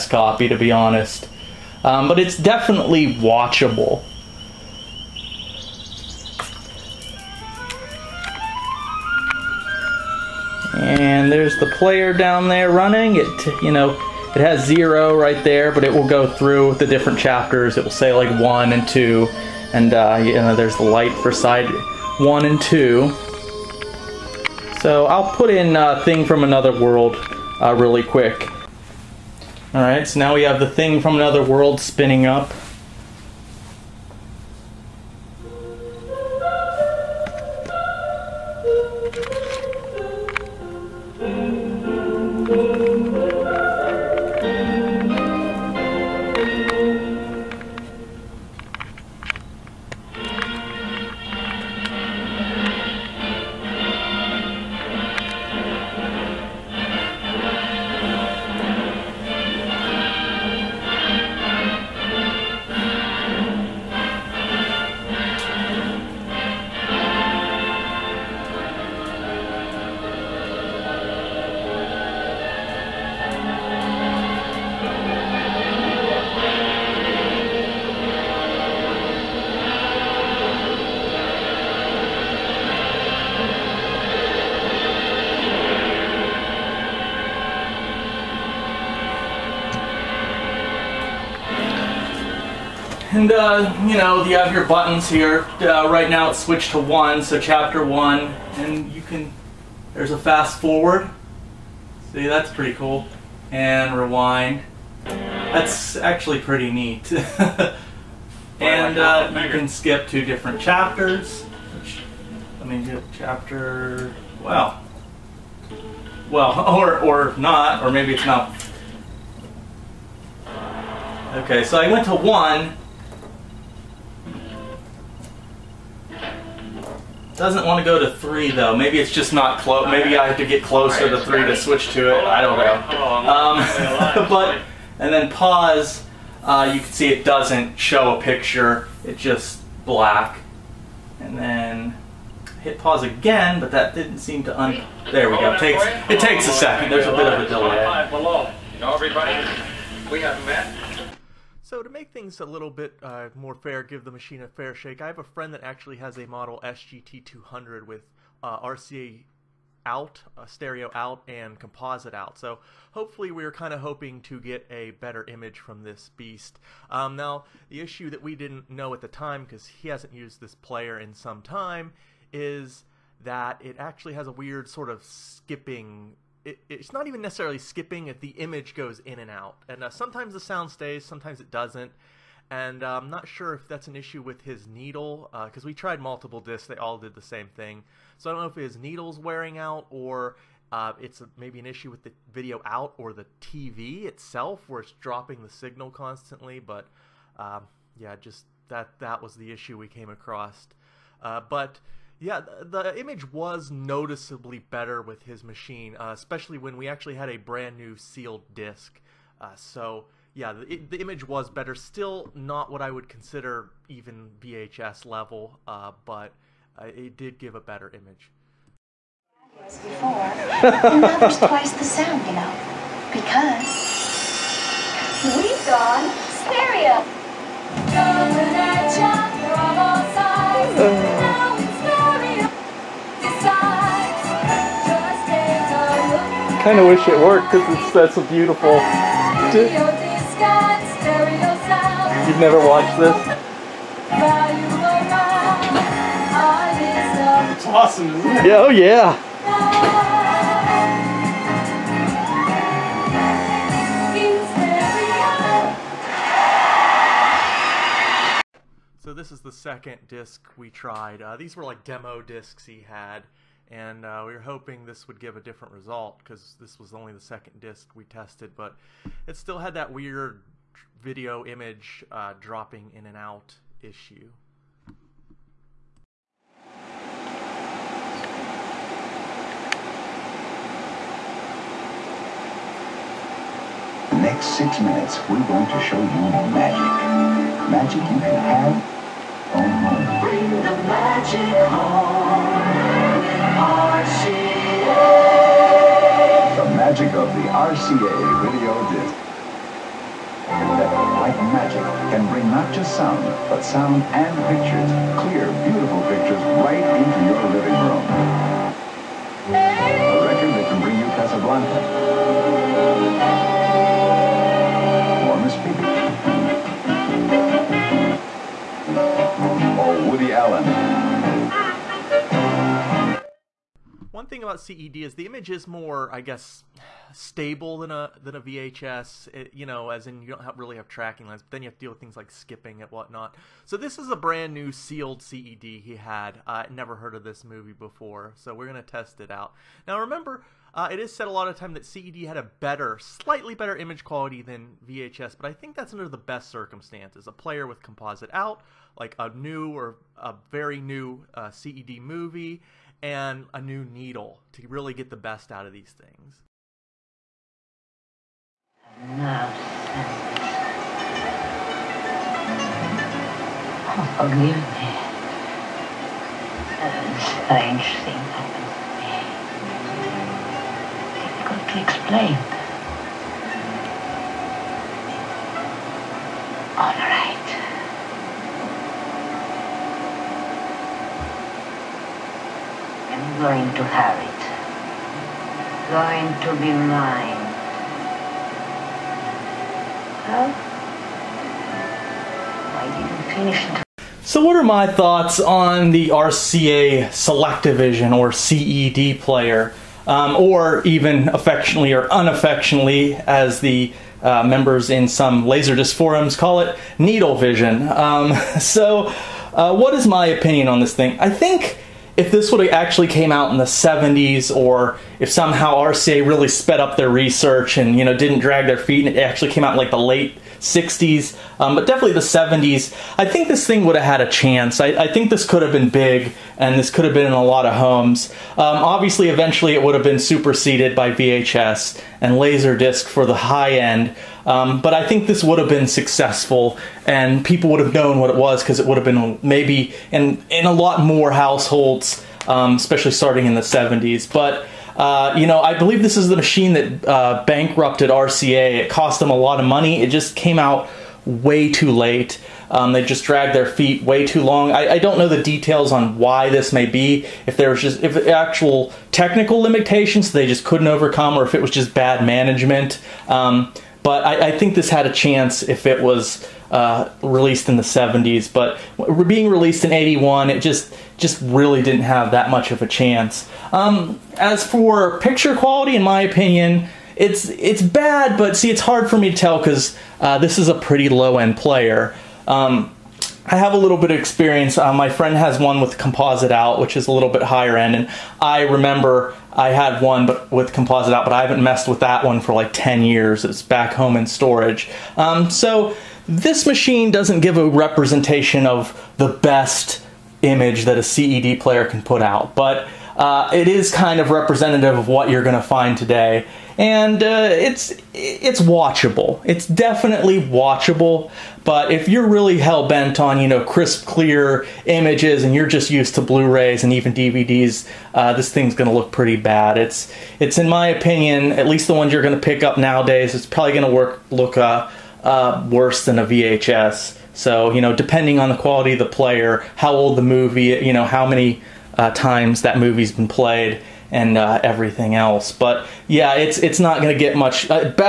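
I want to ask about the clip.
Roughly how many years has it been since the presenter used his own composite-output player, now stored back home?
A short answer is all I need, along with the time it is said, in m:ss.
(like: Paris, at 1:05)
10, at 8:12.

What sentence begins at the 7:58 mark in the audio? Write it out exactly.
But see, it's hard for me to tell because uh, this is a pretty low end player.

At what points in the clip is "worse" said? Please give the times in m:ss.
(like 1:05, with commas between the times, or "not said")
8:45.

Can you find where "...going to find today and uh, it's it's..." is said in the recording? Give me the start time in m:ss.
8:25.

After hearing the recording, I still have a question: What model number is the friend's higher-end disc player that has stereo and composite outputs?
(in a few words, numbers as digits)
SGT 200.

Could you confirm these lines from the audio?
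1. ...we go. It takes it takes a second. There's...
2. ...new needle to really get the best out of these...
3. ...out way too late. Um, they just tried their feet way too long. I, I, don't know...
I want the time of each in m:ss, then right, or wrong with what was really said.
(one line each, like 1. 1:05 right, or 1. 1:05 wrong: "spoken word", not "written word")
1. 2:25 right
2. 5:53 right
3. 7:30 wrong: "dragged", not "tried".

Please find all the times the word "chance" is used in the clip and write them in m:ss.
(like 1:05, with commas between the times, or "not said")
7:04, 7:45, 7:52.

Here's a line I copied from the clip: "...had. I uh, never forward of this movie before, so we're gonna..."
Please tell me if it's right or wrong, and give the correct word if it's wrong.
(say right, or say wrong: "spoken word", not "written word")
wrong: "heard", not "forward".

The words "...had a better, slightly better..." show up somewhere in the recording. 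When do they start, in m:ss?
5:42.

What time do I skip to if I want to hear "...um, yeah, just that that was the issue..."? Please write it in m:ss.
3:17.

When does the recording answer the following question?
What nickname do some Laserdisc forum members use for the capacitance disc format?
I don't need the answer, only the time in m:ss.
6:46.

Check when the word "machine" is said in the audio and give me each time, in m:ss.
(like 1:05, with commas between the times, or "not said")
2:34, 3:25, 7:26, 8:16.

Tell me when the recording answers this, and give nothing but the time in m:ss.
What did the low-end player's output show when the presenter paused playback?
2:19.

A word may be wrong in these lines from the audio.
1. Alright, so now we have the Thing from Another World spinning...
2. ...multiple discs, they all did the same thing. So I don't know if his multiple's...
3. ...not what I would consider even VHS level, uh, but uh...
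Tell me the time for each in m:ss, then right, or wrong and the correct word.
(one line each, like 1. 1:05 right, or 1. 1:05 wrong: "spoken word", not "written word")
1. 0:29 right
2. 3:06 wrong: "needle", not "multiple"
3. 3:32 right.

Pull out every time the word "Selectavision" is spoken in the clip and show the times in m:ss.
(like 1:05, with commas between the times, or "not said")
6:37.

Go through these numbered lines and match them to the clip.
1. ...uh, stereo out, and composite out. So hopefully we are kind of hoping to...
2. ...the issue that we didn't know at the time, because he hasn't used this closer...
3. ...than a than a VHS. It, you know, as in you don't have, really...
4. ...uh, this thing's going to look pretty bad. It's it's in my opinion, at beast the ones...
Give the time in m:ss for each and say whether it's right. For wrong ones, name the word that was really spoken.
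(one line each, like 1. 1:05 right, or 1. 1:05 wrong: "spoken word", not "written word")
1. 2:40 right
2. 2:47 wrong: "player", not "closer"
3. 5:27 right
4. 8:38 wrong: "least", not "beast".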